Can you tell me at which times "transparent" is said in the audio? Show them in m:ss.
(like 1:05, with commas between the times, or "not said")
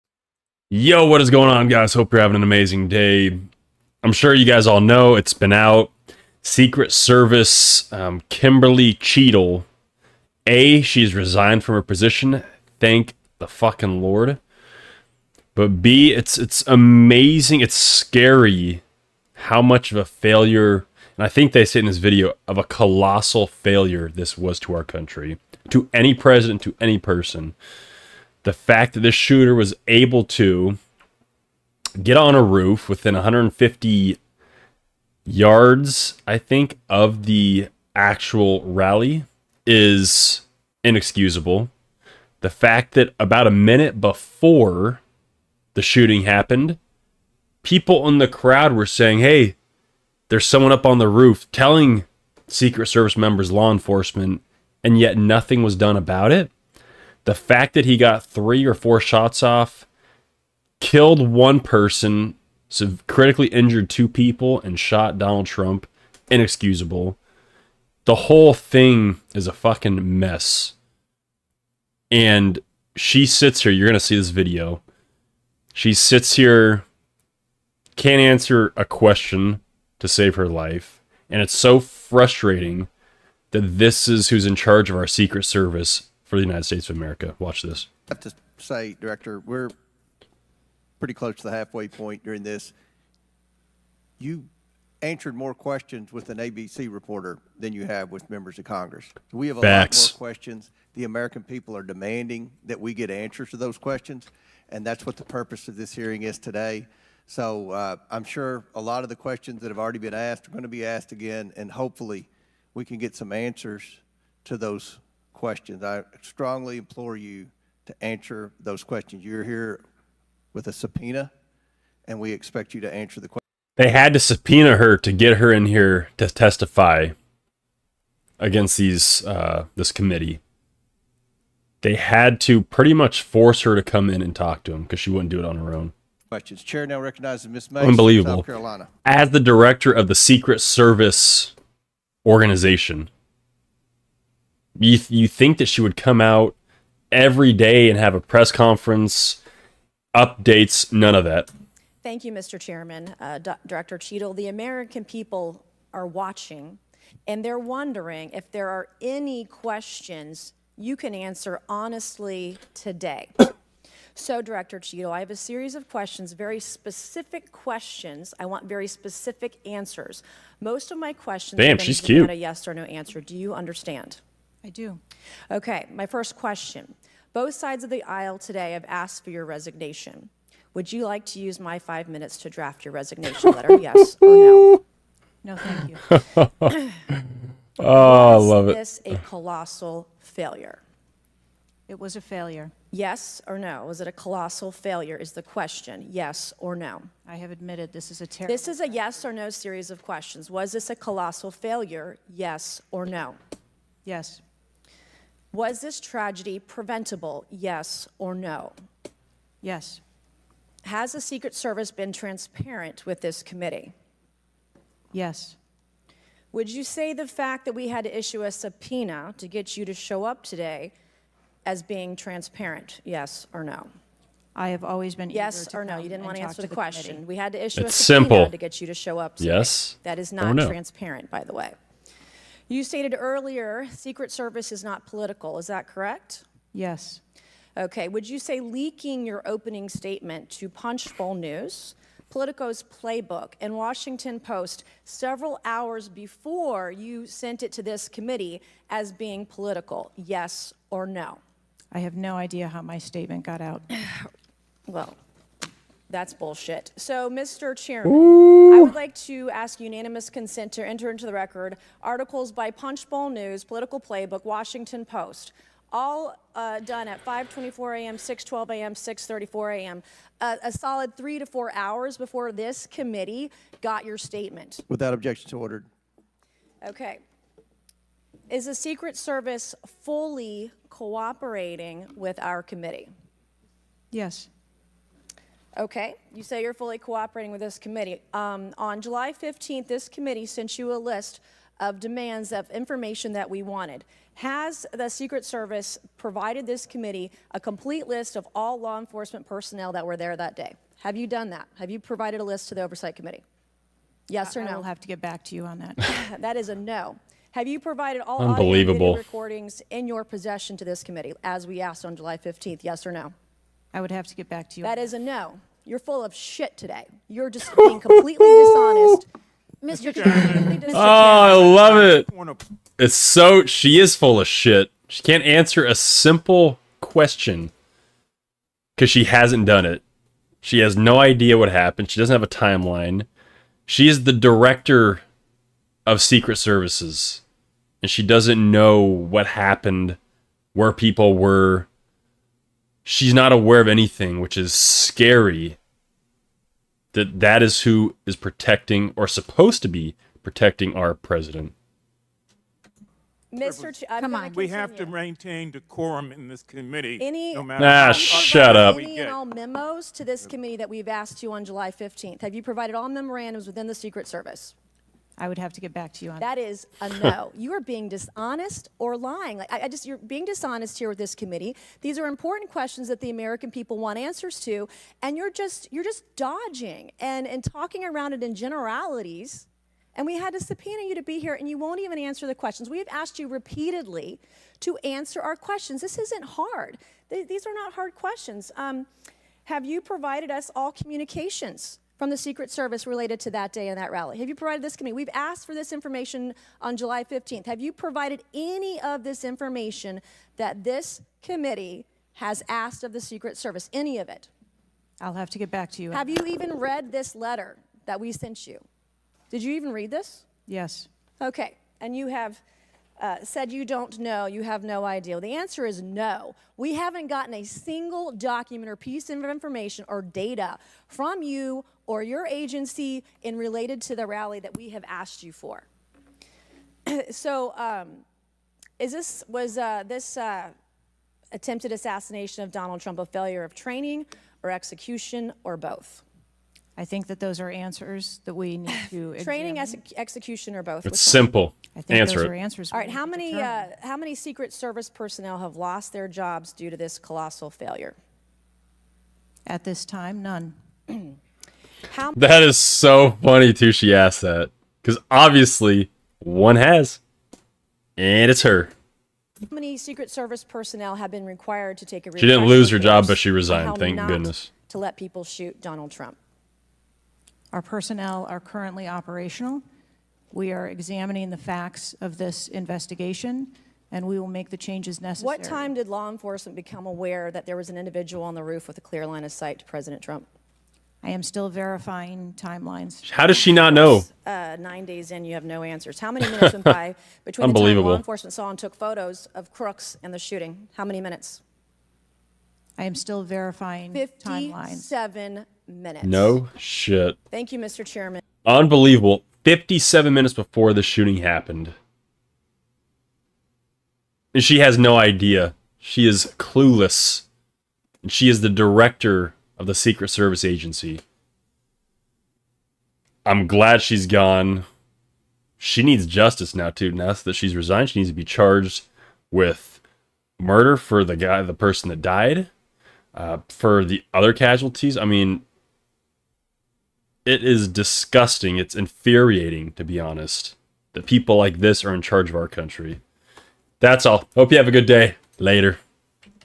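3:32, 3:42, 3:50.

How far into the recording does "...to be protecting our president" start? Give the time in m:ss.
5:49.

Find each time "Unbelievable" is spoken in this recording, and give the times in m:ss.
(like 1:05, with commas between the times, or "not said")
2:17, 5:08, 8:18.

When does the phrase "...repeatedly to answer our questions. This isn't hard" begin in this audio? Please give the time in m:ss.
6:23.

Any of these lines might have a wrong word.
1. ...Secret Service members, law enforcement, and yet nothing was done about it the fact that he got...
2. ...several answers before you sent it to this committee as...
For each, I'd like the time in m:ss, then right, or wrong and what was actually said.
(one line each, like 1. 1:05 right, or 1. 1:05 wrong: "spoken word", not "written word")
1. 0:52 right
2. 4:05 wrong: "hours", not "answers".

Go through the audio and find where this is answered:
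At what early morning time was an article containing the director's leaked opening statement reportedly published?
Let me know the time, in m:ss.
4:27.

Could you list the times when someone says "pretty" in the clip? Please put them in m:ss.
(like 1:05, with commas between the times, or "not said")
1:30, 2:12.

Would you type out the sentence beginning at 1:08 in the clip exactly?
The whole thing is a fucking mess.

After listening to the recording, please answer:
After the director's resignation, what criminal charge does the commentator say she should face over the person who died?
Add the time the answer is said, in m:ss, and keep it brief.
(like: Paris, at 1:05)
Murder, at 8:40.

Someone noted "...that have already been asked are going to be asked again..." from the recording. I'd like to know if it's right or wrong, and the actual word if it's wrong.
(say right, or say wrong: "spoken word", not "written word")
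right.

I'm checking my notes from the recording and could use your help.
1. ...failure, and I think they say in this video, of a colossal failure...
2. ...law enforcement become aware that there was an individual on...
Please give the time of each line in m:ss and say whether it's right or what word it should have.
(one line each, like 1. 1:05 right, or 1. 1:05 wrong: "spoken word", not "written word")
1. 0:20 right
2. 7:56 right.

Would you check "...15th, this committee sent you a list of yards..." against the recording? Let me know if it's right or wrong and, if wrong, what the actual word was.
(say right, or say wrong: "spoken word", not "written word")
wrong: "demands", not "yards".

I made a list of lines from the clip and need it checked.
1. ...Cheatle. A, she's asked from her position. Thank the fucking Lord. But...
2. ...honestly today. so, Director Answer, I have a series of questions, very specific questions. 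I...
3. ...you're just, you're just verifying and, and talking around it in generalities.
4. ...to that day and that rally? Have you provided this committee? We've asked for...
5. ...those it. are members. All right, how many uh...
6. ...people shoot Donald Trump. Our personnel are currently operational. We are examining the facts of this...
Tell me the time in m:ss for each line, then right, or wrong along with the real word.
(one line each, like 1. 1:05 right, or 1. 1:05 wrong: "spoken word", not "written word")
1. 0:08 wrong: "resigned", not "asked"
2. 2:41 wrong: "Cheatle", not "Answer"
3. 6:15 wrong: "dodging", not "verifying"
4. 6:33 right
5. 7:22 wrong: "answers", not "members"
6. 7:45 right.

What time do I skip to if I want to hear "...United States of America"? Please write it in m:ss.
1:26.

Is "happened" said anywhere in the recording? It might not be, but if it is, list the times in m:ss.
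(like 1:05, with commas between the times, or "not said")
0:46, 5:31, 5:39, 8:21.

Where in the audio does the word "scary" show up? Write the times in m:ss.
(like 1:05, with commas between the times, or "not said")
0:17, 5:44.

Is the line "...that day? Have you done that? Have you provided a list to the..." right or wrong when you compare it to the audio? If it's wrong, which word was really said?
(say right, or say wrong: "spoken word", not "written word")
right.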